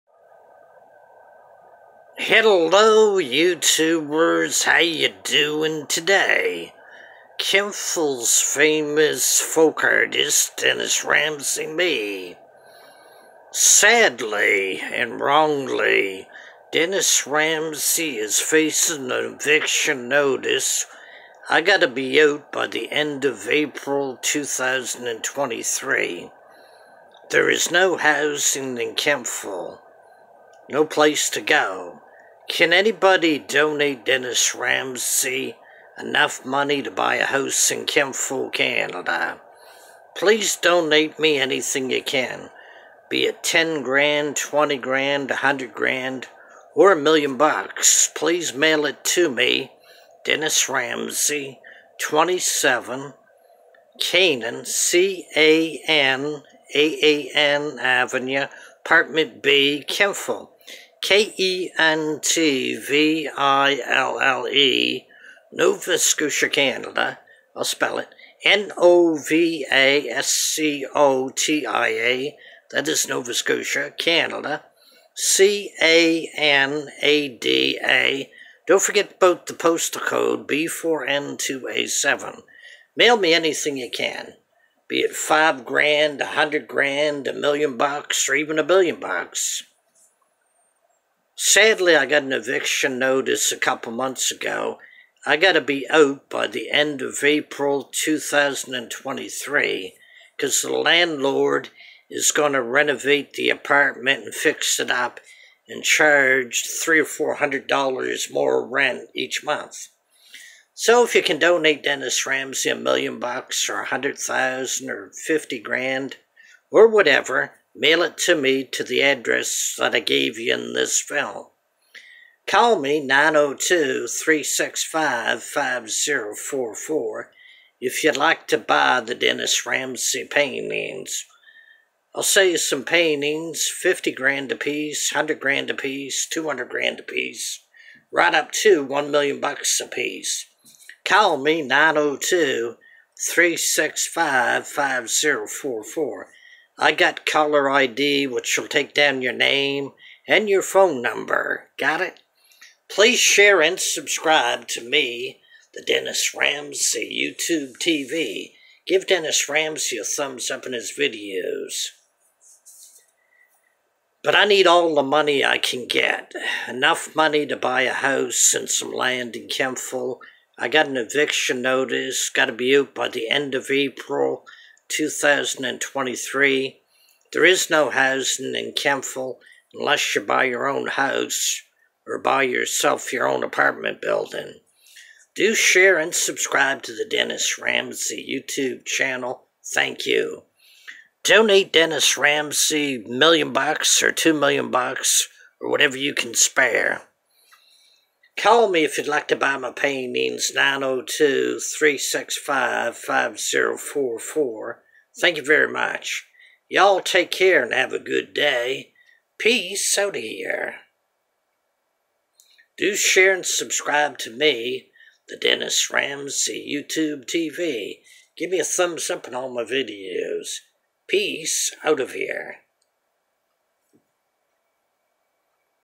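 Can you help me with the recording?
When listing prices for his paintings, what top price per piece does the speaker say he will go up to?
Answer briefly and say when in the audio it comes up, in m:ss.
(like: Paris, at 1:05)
$1 million, at 2:18.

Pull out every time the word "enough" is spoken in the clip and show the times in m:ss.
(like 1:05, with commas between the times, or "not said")
0:35, 2:46.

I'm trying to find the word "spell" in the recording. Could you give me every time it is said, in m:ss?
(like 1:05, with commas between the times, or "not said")
1:07.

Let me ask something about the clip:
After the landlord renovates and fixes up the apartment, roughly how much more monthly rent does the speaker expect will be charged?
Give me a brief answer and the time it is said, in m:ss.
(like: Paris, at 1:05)
$300 or $400, at 1:46.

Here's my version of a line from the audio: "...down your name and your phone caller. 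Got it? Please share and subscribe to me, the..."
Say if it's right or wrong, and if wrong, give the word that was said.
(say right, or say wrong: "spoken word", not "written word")
wrong: "number", not "caller".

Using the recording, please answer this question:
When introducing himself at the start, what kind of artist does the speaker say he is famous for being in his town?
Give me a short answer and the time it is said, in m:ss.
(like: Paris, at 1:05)
Folk artist, at 0:09.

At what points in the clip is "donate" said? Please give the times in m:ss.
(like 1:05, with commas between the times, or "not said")
0:33, 0:40, 1:51, 3:11.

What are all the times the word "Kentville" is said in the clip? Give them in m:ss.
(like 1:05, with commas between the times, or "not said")
0:07, 0:28, 0:37, 0:59, 2:49, 2:58.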